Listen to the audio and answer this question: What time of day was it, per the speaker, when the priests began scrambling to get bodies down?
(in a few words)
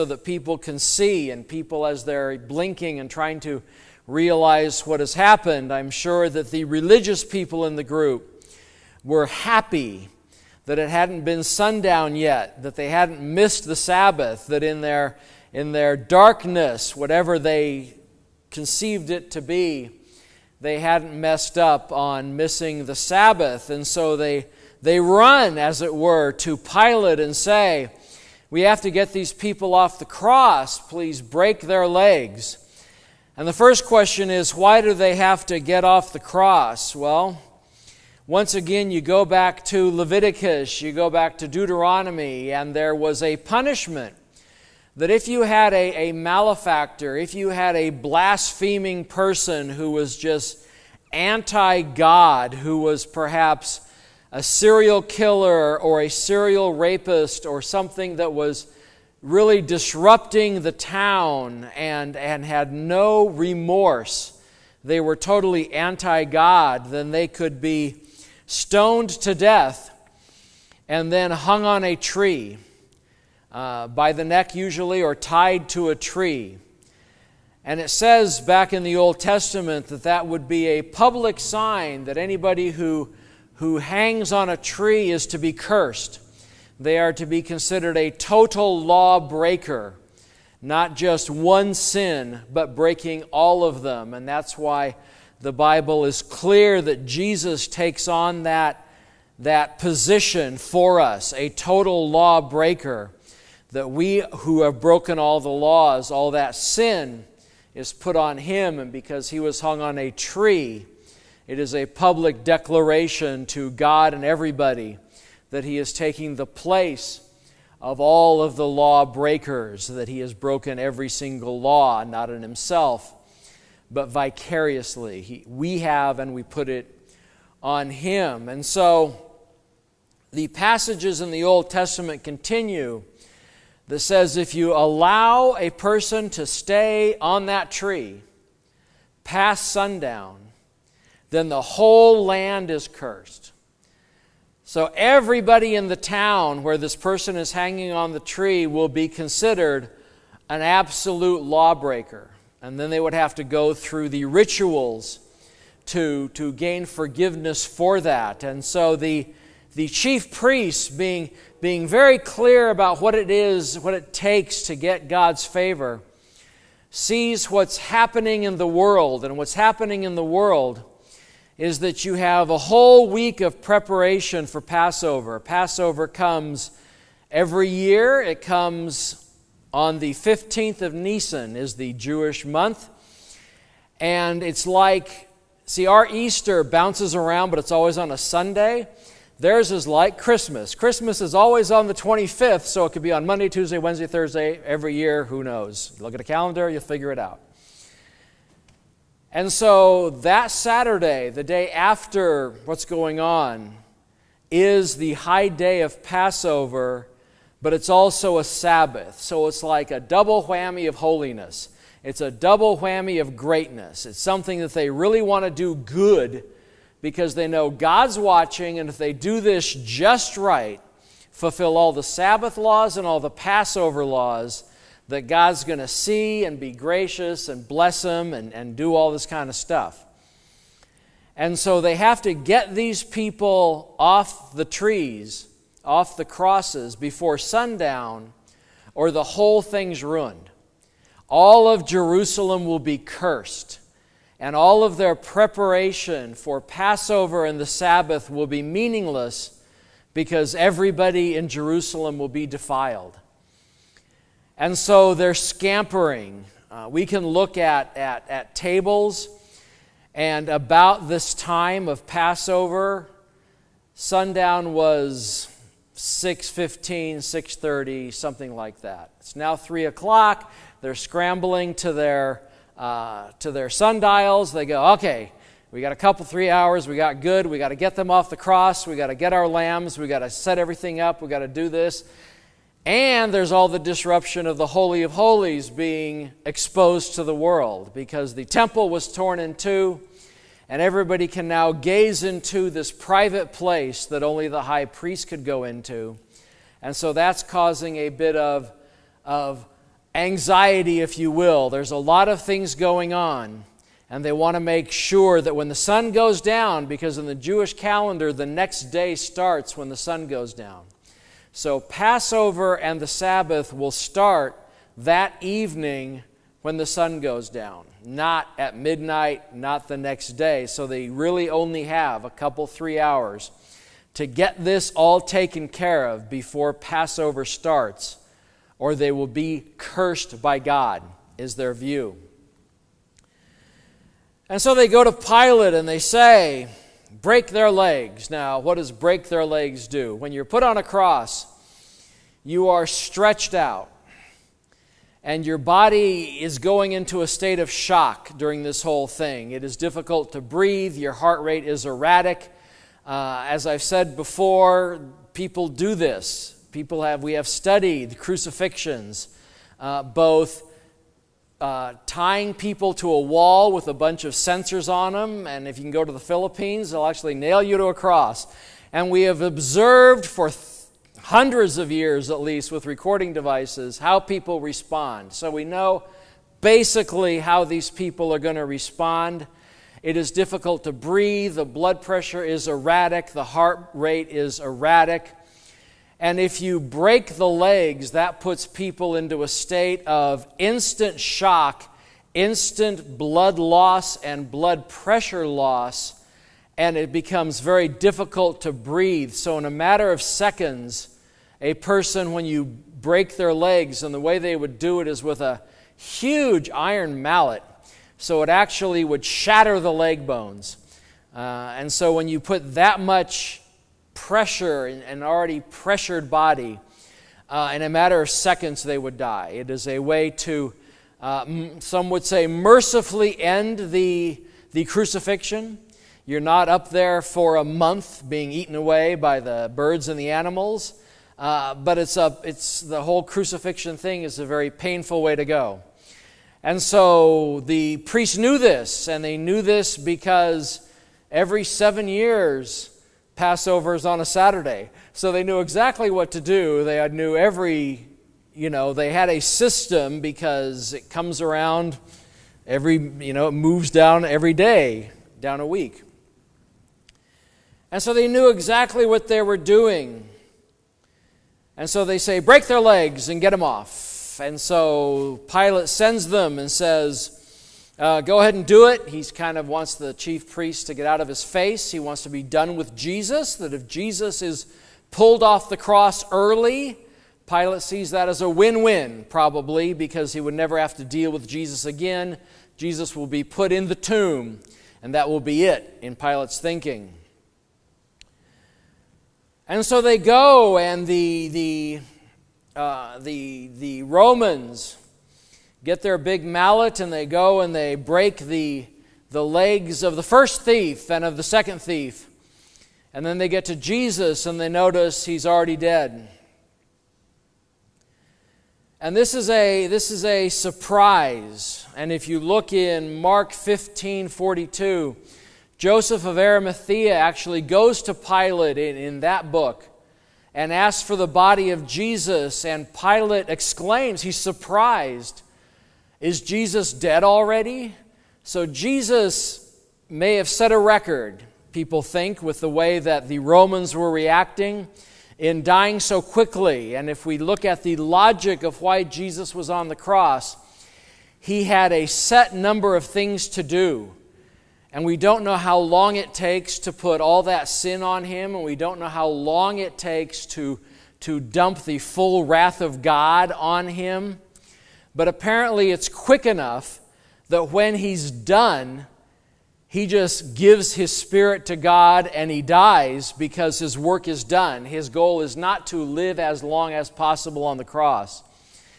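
3 o'clock.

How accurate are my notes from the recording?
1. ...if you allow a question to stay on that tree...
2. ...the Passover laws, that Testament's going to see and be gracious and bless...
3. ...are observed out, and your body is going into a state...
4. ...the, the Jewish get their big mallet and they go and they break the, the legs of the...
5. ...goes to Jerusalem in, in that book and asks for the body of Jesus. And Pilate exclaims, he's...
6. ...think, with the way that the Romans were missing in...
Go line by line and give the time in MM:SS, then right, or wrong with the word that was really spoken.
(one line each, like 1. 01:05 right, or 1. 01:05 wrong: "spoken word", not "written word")
1. 02:14 wrong: "person", not "question"
2. 03:43 wrong: "God", not "Testament"
3. 05:42 wrong: "stretched", not "observed"
4. 08:13 wrong: "Romans", not "Jewish"
5. 08:37 wrong: "Pilate", not "Jerusalem"
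6. 08:52 wrong: "reacting", not "missing".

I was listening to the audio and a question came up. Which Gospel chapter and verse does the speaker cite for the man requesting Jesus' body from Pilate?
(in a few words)
Mark 15:42.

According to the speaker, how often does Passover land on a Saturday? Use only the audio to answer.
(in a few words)
every seven years.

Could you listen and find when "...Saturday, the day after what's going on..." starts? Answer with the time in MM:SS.
03:20.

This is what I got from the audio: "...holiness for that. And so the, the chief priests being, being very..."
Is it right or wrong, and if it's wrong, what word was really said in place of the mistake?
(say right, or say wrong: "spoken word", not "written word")
wrong: "forgiveness", not "holiness".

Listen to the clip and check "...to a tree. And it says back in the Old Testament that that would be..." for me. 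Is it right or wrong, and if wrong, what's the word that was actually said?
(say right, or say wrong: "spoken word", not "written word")
right.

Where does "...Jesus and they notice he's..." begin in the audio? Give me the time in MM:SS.
08:23.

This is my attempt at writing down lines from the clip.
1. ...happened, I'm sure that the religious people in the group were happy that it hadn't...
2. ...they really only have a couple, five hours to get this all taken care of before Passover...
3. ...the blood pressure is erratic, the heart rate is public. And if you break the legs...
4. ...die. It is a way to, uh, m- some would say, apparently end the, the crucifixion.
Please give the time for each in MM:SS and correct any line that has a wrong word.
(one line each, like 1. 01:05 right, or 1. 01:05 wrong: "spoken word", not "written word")
1. 00:05 right
2. 05:20 wrong: "three", not "five"
3. 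06:21 wrong: "erratic", not "public"
4. 06:59 wrong: "mercifully", not "apparently".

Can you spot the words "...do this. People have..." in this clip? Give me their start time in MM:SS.
05:55.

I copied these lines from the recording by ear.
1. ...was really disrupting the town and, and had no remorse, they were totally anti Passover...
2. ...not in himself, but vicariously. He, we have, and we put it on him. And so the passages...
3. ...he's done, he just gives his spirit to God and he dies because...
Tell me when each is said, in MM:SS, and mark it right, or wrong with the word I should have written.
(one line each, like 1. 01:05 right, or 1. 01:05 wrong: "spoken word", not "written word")
1. 00:58 wrong: "God", not "Passover"
2. 02:02 right
3. 09:17 right.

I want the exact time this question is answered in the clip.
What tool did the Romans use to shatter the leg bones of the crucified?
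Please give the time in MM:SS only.
06:46.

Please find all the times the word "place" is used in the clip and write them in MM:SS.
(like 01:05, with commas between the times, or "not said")
01:56, 04:53.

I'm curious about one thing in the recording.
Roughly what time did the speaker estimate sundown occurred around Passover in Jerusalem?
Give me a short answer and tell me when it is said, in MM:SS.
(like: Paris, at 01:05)
6:15, at 04:25.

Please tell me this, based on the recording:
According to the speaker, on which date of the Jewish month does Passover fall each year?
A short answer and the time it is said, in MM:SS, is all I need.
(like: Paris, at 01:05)
15th of Nisan, at 03:00.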